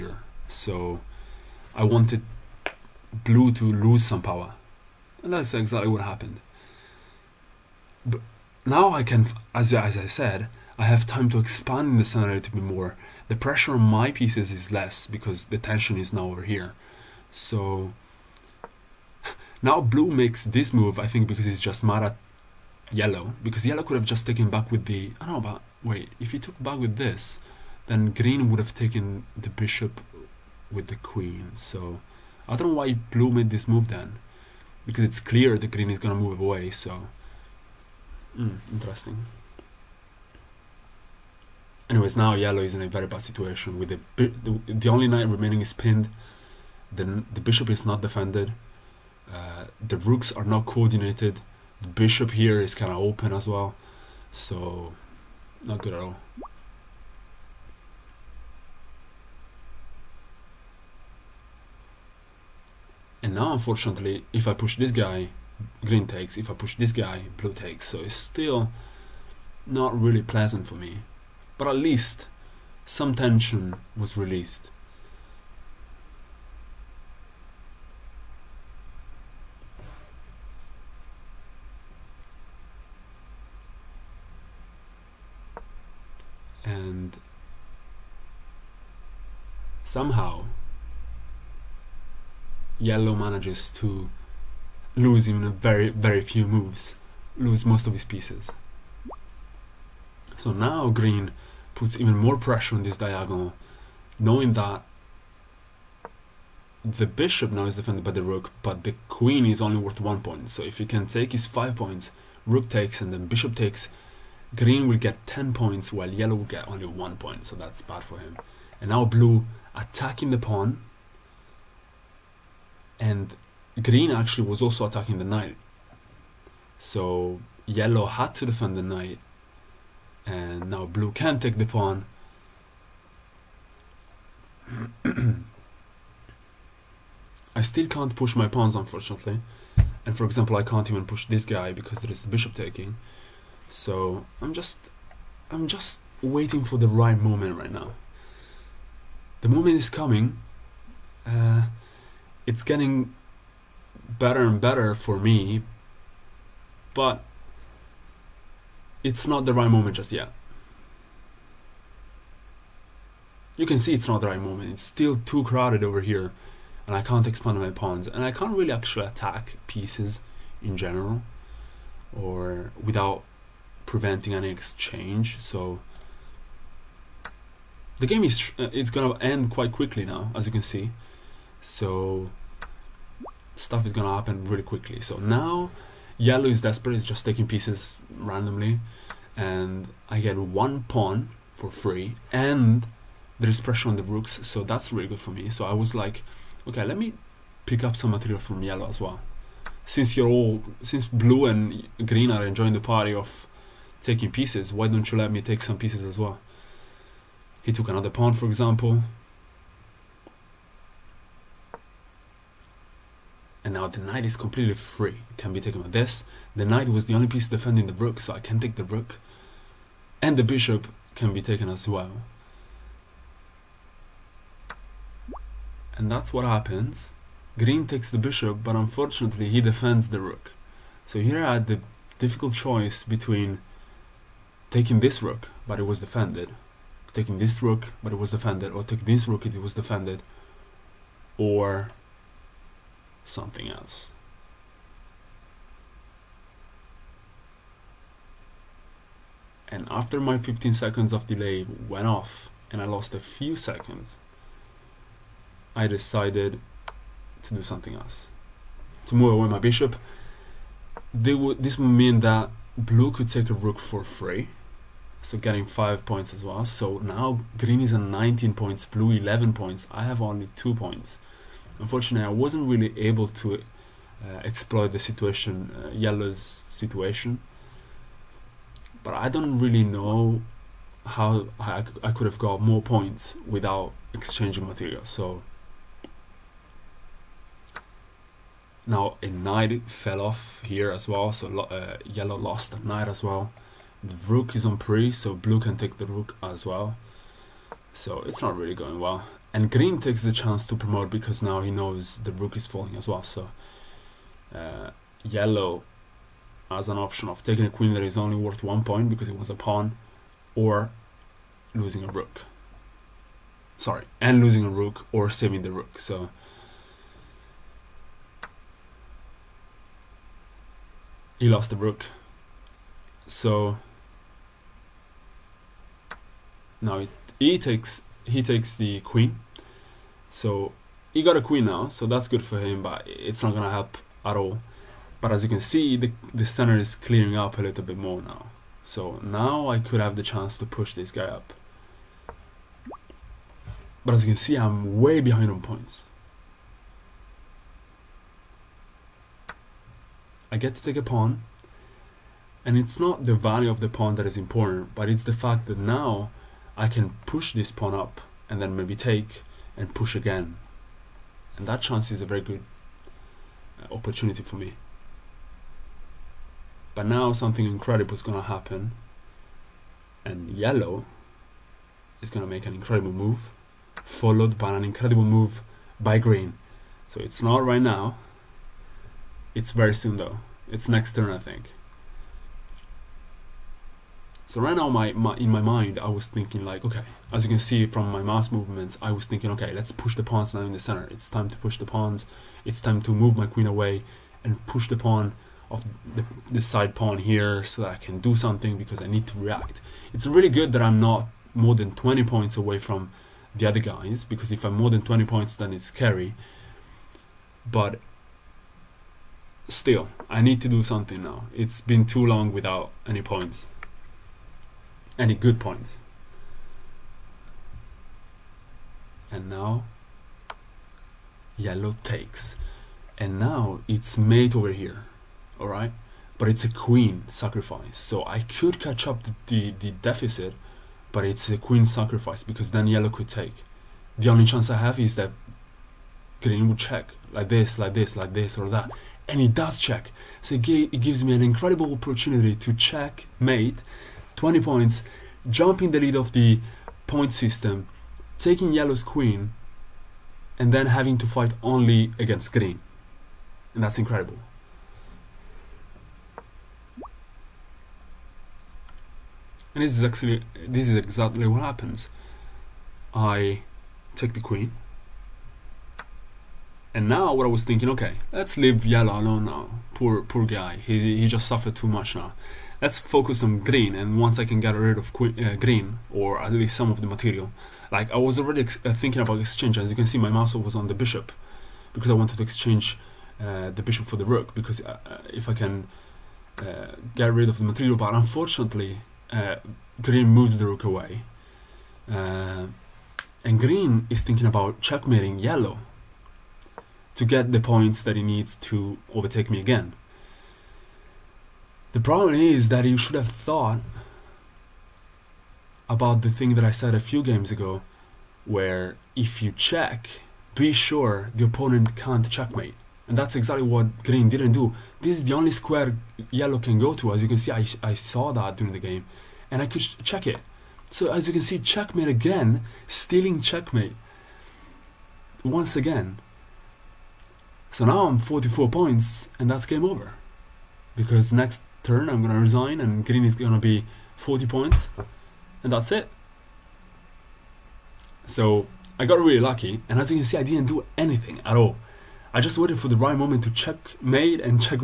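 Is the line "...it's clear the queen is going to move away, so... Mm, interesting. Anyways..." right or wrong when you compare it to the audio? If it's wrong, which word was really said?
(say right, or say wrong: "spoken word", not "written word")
wrong: "green", not "queen".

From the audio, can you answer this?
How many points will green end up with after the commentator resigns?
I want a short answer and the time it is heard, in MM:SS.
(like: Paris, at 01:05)
40 points, at 08:54.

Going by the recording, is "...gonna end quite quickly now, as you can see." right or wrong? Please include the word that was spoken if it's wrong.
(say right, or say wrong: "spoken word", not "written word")
right.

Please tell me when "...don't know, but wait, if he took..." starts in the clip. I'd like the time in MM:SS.
00:25.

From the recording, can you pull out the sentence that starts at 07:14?
The only chance I have is that green would check like this, like this, like this, or that.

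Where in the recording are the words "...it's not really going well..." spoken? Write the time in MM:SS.
04:58.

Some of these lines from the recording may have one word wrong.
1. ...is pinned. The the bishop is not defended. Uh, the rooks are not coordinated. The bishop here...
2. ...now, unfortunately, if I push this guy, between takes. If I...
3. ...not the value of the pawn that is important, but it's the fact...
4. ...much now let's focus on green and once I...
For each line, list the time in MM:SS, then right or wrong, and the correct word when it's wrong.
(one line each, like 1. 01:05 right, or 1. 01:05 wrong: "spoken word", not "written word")
1. 00:45 right
2. 01:03 wrong: "green", not "between"
3. 05:52 right
4. 07:51 right.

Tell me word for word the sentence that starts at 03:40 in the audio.
And the bishop can be taken as well.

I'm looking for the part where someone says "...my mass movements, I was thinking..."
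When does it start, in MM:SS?
06:28.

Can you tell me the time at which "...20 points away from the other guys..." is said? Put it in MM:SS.
06:41.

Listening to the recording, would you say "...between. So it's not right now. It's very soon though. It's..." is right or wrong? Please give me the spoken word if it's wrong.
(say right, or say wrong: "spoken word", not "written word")
wrong: "green", not "between".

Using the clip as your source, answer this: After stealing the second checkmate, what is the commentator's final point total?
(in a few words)
44 points.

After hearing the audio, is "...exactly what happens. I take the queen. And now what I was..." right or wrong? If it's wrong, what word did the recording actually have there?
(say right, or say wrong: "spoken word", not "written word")
right.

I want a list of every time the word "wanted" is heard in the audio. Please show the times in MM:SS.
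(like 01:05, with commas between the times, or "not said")
00:01, 08:02.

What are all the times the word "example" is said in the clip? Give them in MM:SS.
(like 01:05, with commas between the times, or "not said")
02:20, 03:28.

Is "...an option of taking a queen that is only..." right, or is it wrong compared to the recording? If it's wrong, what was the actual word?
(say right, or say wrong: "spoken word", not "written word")
right.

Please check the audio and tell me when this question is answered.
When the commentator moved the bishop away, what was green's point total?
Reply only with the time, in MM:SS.
04:28.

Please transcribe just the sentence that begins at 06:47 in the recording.
But still, I need to do something now.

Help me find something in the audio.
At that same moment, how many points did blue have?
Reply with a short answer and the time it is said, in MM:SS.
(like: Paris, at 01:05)
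11 points, at 04:28.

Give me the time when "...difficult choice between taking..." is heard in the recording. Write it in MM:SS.
03:52.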